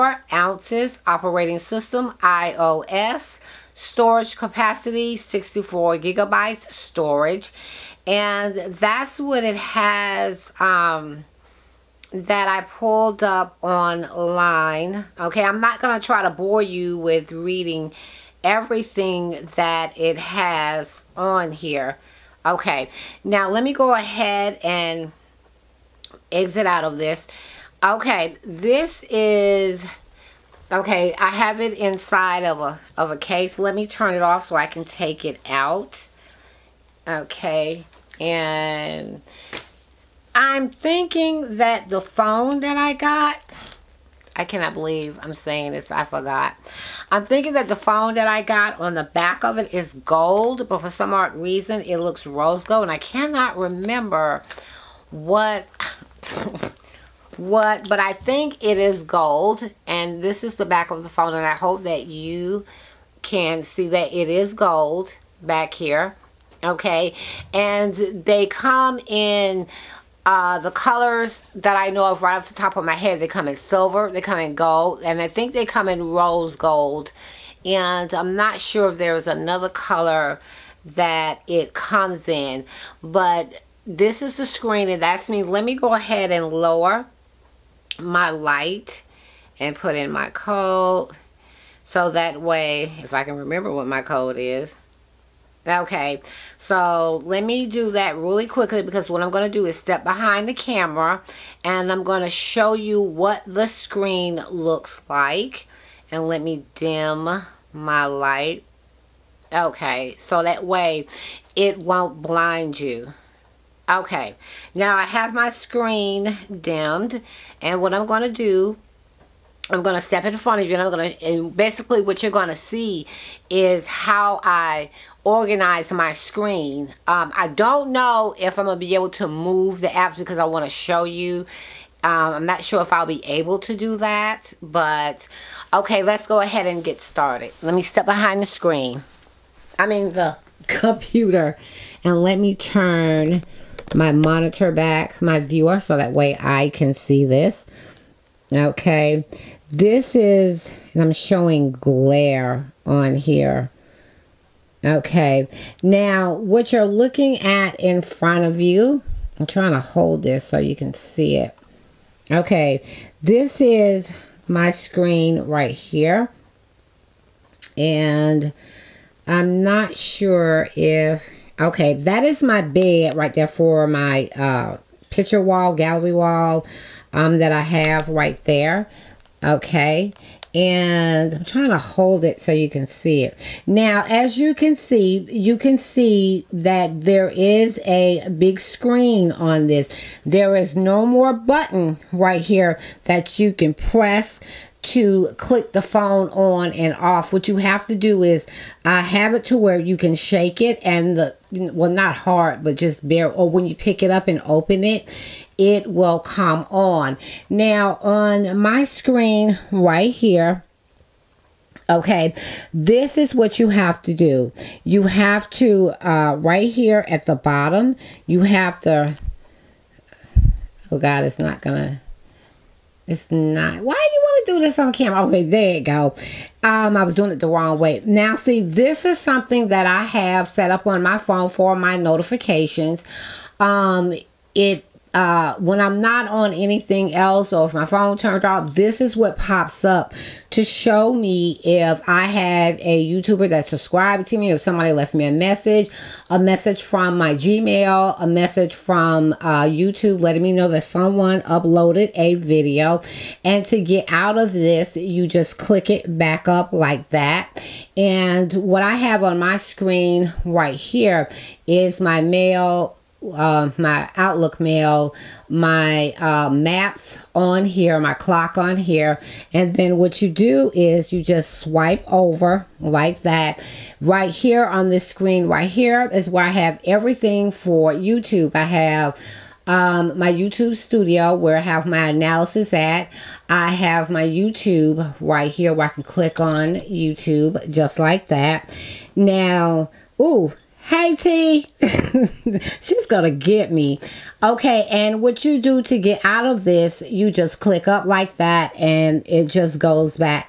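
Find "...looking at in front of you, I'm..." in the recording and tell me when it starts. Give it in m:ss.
2:36.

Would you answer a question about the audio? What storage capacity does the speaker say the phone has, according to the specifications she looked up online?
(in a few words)
64 gigabytes.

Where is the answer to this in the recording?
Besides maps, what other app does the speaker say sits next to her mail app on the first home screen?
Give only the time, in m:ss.
4:28.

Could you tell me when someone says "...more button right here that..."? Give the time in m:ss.
3:11.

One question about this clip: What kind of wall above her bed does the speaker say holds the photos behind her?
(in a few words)
gallery wall.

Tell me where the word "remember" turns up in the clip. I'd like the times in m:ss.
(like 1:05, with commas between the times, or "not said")
0:53, 1:33.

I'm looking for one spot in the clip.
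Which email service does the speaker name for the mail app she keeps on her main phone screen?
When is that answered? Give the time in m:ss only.
4:24.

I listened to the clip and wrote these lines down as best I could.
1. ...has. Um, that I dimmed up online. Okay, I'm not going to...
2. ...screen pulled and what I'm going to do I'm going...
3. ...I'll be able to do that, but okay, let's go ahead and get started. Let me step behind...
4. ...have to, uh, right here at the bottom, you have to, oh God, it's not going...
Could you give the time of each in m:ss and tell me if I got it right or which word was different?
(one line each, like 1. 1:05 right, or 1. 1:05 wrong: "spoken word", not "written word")
1. 0:09 wrong: "pulled", not "dimmed"
2. 1:55 wrong: "dimmed", not "pulled"
3. 2:12 right
4. 3:35 right.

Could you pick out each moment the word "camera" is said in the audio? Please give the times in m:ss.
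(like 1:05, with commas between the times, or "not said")
1:40, 3:44.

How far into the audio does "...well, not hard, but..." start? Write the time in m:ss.
3:21.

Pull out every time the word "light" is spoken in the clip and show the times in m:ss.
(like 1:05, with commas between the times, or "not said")
1:28, 1:48.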